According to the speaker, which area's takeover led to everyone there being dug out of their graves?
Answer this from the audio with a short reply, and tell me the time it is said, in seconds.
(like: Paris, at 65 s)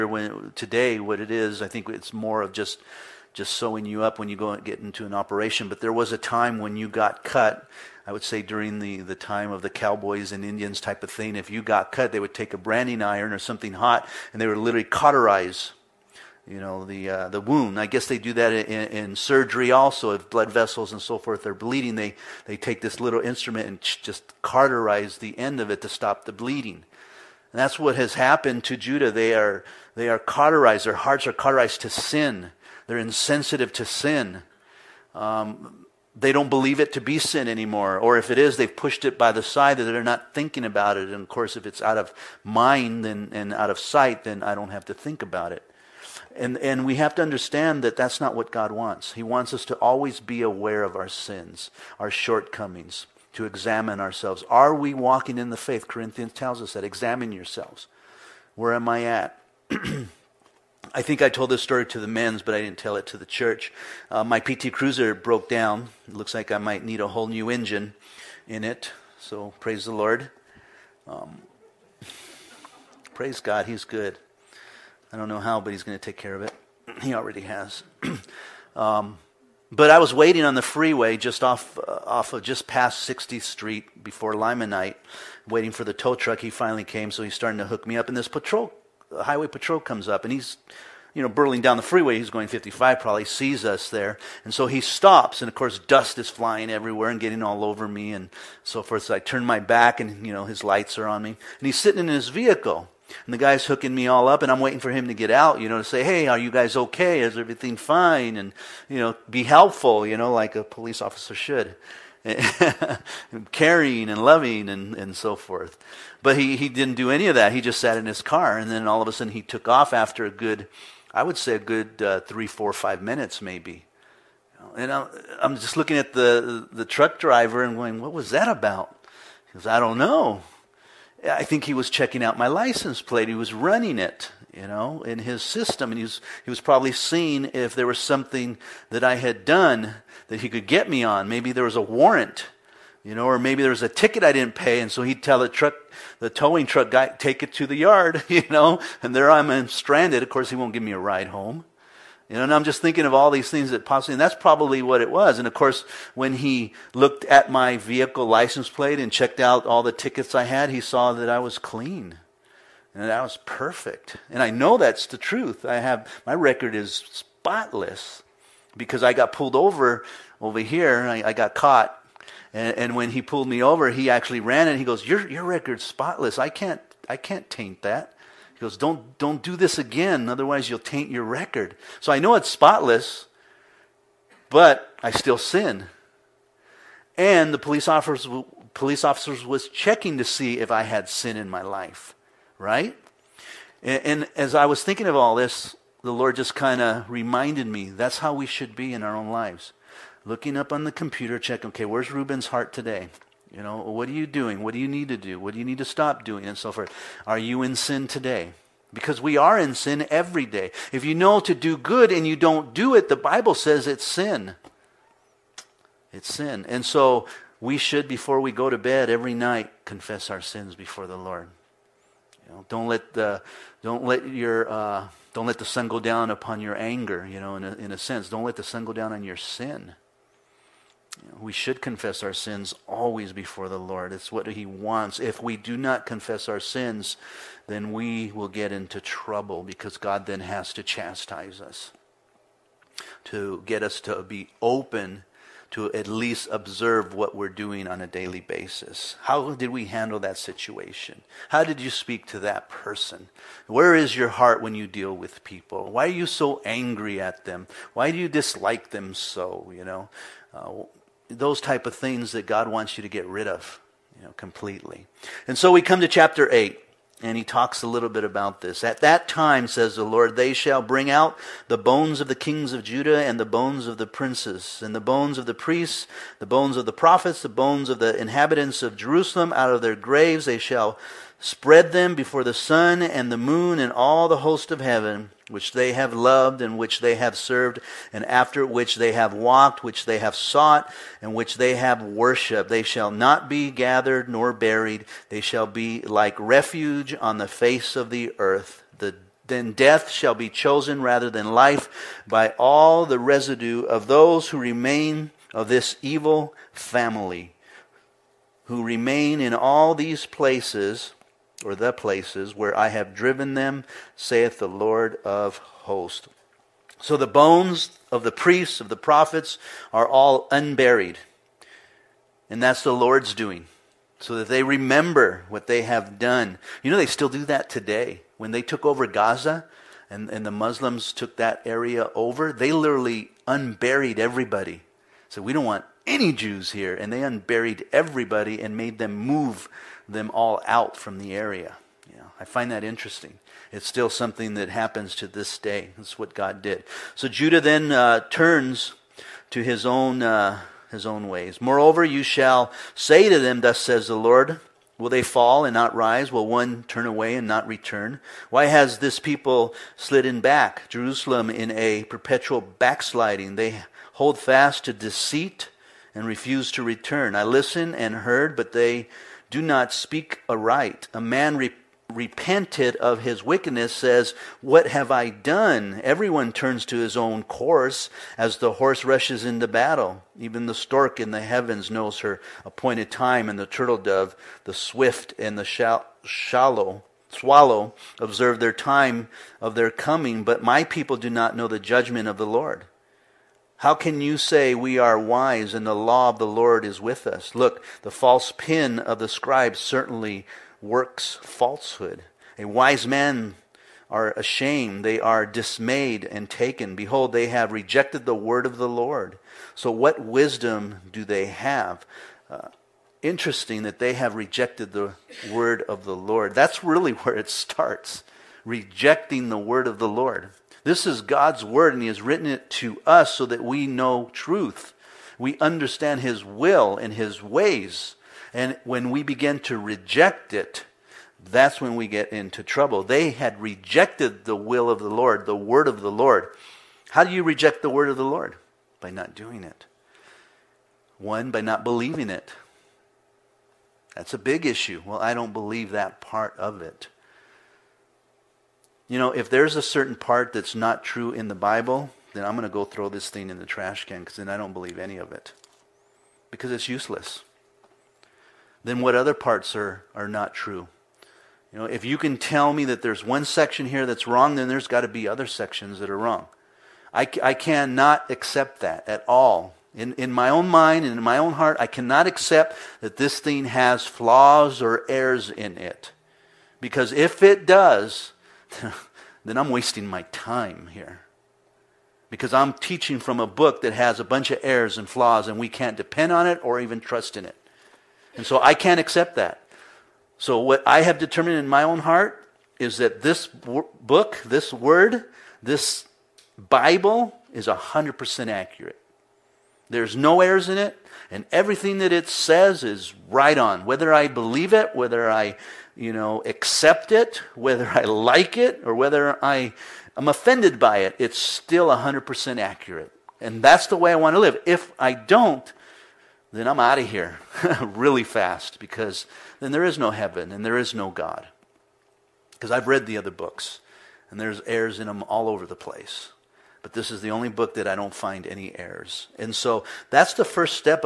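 Gaza, at 329 s.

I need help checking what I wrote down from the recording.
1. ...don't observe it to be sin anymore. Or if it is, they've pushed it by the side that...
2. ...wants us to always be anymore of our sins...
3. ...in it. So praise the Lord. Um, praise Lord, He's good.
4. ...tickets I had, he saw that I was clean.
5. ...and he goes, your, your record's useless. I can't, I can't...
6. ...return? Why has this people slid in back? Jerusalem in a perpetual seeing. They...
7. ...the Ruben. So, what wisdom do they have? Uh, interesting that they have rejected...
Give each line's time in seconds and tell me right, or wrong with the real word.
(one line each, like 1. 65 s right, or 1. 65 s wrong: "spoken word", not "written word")
1. 36 s wrong: "believe", not "observe"
2. 49 s wrong: "aware", not "anymore"
3. 68 s wrong: "God", not "Lord"
4. 159 s right
5. 174 s wrong: "spotless", not "useless"
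6. 357 s wrong: "backsliding", not "seeing"
7. 408 s wrong: "Lord", not "Ruben".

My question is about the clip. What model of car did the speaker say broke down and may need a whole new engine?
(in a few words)
PT Cruiser.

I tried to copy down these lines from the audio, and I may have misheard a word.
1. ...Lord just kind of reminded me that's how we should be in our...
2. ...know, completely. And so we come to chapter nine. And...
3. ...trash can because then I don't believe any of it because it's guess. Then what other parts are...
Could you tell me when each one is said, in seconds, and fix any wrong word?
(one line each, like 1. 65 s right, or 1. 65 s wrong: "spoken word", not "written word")
1. 196 s right
2. 264 s wrong: "eight", not "nine"
3. 453 s wrong: "useless", not "guess".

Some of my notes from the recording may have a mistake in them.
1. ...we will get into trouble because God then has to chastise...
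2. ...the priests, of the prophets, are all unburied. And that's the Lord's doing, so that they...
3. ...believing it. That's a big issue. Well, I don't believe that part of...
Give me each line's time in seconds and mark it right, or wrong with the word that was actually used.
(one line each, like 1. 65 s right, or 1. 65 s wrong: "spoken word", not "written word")
1. 237 s right
2. 318 s right
3. 441 s right.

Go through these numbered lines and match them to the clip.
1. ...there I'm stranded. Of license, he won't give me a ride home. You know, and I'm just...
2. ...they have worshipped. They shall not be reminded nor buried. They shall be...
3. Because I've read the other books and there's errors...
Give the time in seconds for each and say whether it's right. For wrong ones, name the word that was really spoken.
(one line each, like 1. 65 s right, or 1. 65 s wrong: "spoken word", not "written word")
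1. 149 s wrong: "course", not "license"
2. 291 s wrong: "gathered", not "reminded"
3. 522 s right.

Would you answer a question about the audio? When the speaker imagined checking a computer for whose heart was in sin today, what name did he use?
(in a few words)
Ruben.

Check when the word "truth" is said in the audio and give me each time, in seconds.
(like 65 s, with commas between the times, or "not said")
165 s, 424 s.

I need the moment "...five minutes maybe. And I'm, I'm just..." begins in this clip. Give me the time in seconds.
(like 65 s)
122 s.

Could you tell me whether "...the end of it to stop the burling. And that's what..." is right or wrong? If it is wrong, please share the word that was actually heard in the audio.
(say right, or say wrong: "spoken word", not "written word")
wrong: "bleeding", not "burling".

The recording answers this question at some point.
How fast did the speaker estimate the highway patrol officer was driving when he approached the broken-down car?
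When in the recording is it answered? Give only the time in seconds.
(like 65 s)
92 s.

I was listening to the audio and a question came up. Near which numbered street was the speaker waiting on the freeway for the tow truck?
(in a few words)
60th Street.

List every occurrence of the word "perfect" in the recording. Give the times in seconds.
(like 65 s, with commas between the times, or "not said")
163 s.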